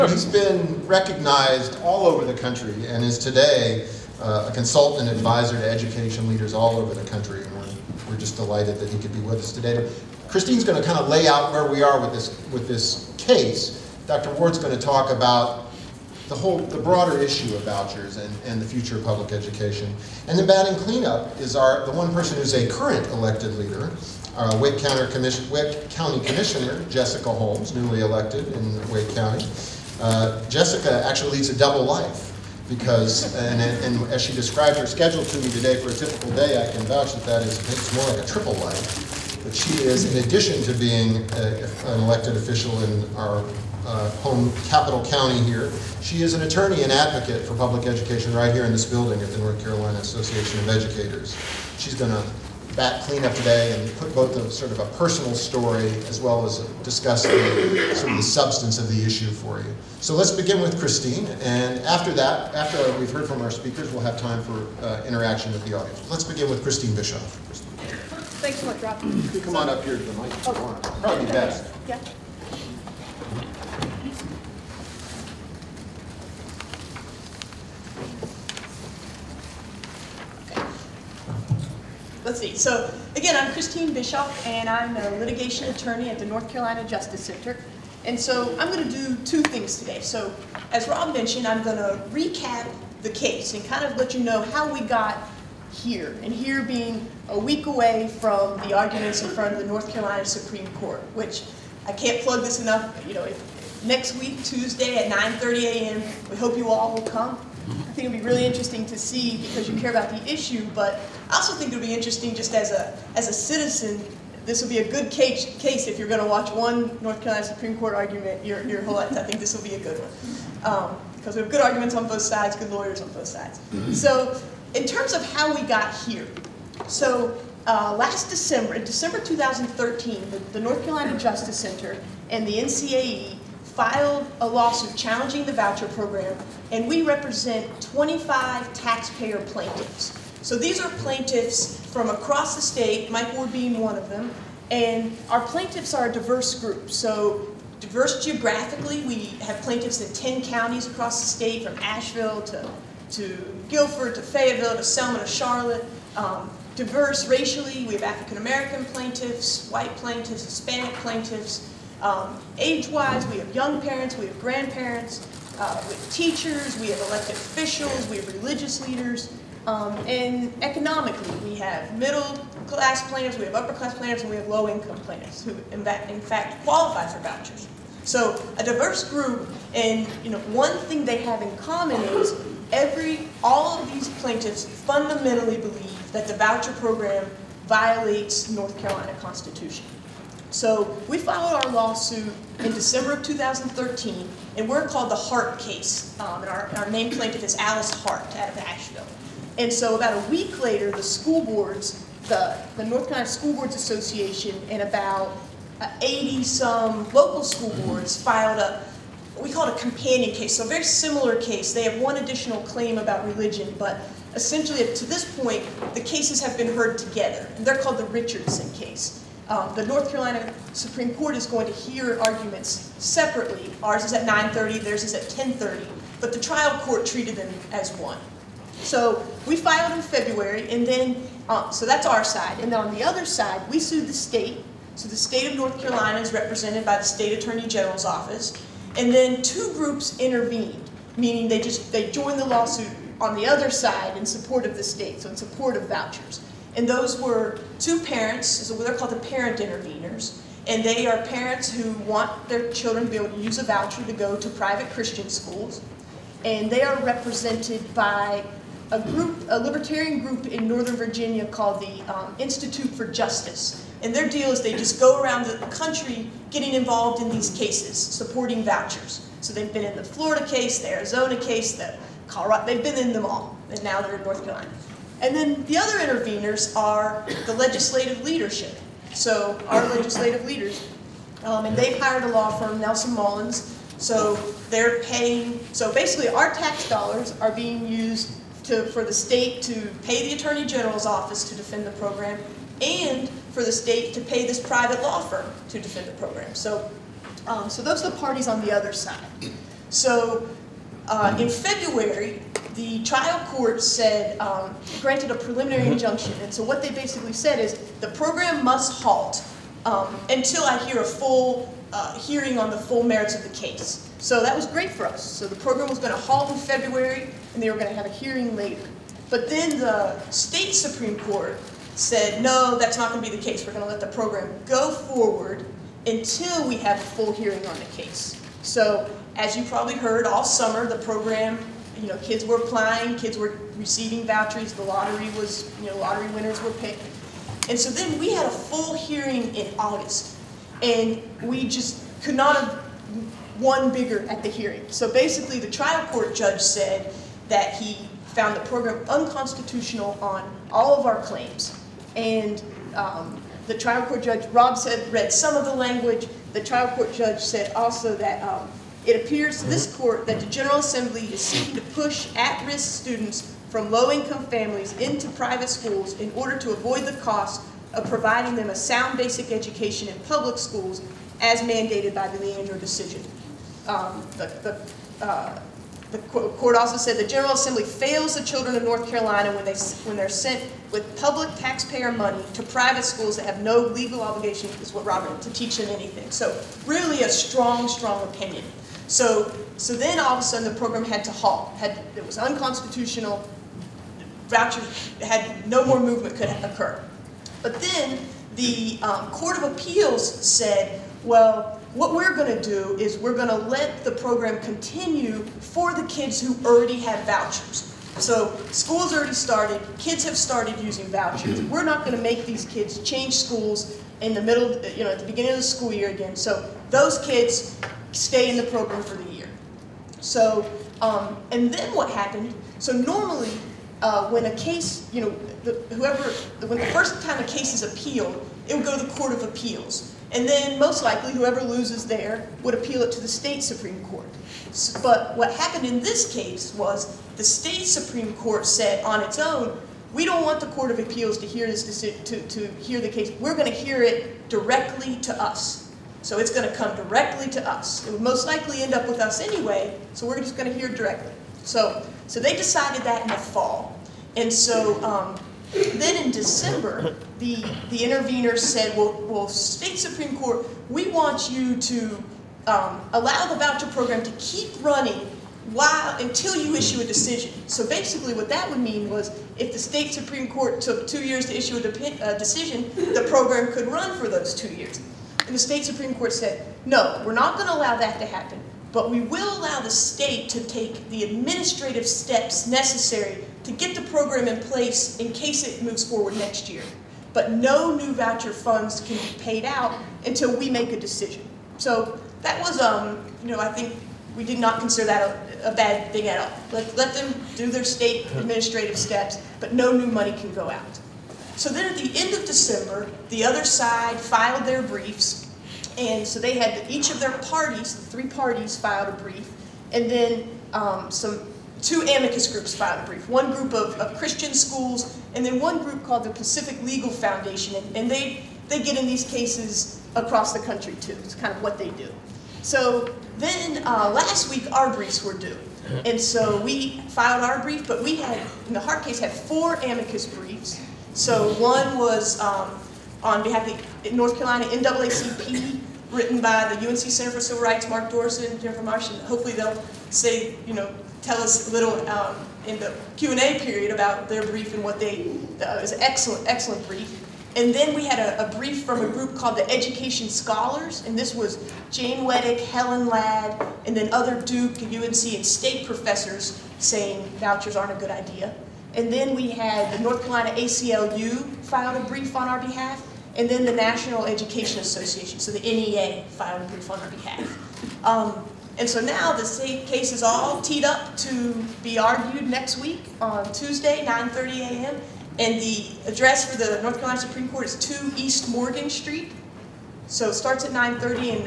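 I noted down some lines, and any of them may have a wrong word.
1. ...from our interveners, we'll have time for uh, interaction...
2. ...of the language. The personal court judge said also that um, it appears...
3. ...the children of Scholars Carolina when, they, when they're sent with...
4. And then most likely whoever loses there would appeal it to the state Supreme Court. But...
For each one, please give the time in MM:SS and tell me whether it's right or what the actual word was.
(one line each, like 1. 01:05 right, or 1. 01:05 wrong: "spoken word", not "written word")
1. 01:03 wrong: "speakers", not "interveners"
2. 05:55 wrong: "trial", not "personal"
3. 06:18 wrong: "North", not "Scholars"
4. 07:10 right.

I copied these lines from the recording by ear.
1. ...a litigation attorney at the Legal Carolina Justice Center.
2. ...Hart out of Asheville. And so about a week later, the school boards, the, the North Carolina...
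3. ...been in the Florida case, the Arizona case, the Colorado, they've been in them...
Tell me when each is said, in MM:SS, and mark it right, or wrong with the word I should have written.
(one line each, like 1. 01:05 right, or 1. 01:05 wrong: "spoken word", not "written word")
1. 01:24 wrong: "North", not "Legal"
2. 03:18 right
3. 04:29 right.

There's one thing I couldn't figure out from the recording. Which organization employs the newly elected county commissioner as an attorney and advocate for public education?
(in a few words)
North Carolina Association of Educators.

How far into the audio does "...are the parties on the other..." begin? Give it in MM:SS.
04:58.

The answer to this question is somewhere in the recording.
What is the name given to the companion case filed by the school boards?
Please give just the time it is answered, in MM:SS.
03:37.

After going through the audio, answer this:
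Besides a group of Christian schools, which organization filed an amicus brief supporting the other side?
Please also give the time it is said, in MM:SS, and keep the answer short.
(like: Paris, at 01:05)
Pacific Legal Foundation, at 08:36.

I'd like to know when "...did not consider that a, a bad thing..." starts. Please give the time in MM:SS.
08:14.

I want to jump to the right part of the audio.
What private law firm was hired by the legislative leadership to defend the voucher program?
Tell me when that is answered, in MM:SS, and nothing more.
04:42.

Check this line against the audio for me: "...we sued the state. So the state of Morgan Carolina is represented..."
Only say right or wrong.
wrong.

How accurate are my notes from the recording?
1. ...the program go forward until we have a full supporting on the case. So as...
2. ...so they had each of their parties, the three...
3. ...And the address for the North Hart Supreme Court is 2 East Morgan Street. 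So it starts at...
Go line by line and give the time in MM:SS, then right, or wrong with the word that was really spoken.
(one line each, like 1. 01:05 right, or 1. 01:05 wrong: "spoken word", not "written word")
1. 05:24 wrong: "hearing", not "supporting"
2. 08:26 right
3. 09:35 wrong: "Carolina", not "Hart".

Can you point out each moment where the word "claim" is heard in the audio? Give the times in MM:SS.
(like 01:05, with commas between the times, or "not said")
03:32, 05:51.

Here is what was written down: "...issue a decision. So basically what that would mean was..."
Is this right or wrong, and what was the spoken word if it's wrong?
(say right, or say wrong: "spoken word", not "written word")
right.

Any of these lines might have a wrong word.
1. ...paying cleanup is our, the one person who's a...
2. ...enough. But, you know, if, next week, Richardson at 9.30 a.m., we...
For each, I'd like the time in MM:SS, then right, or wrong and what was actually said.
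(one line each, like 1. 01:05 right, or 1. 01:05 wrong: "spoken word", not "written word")
1. 00:20 wrong: "batting", not "paying"
2. 01:42 wrong: "Tuesday", not "Richardson".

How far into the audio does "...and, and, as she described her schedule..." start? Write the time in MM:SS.
00:33.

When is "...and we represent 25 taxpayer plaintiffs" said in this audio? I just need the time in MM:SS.
02:16.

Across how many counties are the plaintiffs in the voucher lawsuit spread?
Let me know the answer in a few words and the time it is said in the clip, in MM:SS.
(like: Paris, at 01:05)
10, at 02:30.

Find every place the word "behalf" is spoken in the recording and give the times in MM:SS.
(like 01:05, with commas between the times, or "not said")
08:53, 09:22, 09:27.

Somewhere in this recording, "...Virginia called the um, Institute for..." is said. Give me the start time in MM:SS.
04:20.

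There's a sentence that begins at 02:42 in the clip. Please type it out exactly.
Um, Age-wise, we have young parents, we have grandparents, uh, we have teachers, we have elected officials, we have religious leaders.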